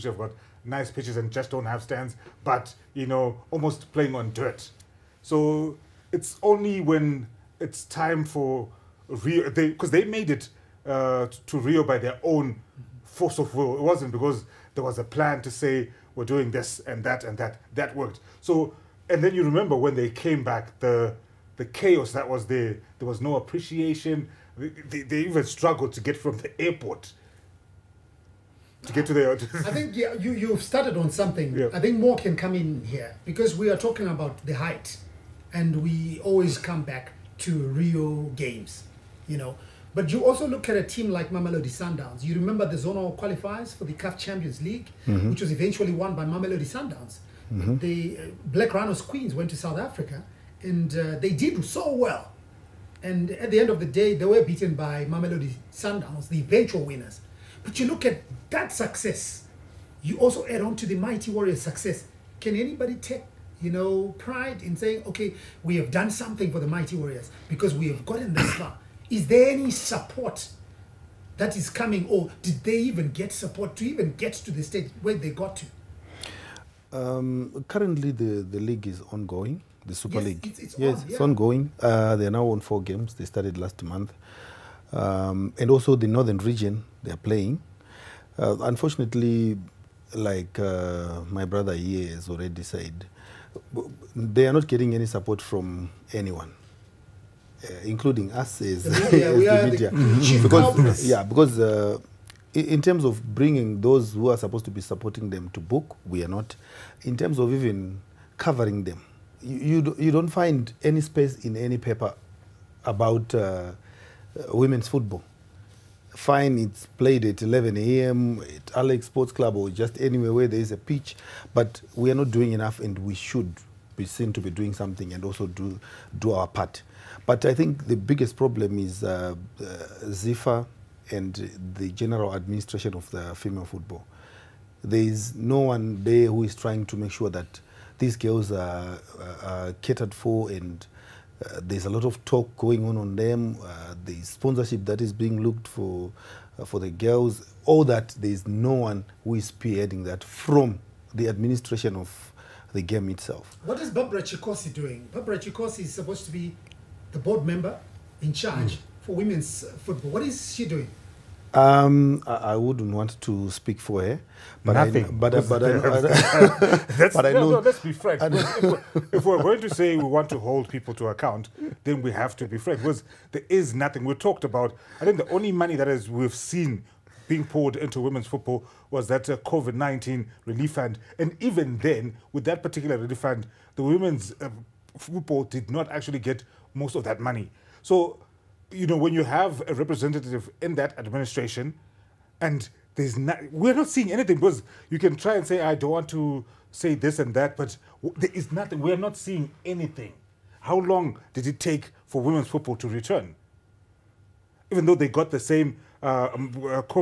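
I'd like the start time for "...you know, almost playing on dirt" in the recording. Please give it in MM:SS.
00:02.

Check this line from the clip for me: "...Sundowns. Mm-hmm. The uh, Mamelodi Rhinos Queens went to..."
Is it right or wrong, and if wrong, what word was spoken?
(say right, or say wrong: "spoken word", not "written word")
wrong: "Black", not "Mamelodi".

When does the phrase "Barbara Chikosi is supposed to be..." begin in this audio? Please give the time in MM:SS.
02:35.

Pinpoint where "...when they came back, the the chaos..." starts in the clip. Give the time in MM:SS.
00:19.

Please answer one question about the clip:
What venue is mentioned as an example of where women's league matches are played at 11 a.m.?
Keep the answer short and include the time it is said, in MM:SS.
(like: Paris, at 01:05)
Alex Sports Club, at 01:58.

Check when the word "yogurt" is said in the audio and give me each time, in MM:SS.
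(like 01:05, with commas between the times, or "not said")
not said.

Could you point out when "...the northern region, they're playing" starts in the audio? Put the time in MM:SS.
01:25.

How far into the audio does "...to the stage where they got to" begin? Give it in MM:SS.
01:14.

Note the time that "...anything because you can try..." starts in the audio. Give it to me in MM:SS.
03:14.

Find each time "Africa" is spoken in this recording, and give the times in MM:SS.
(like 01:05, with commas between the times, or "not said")
00:49.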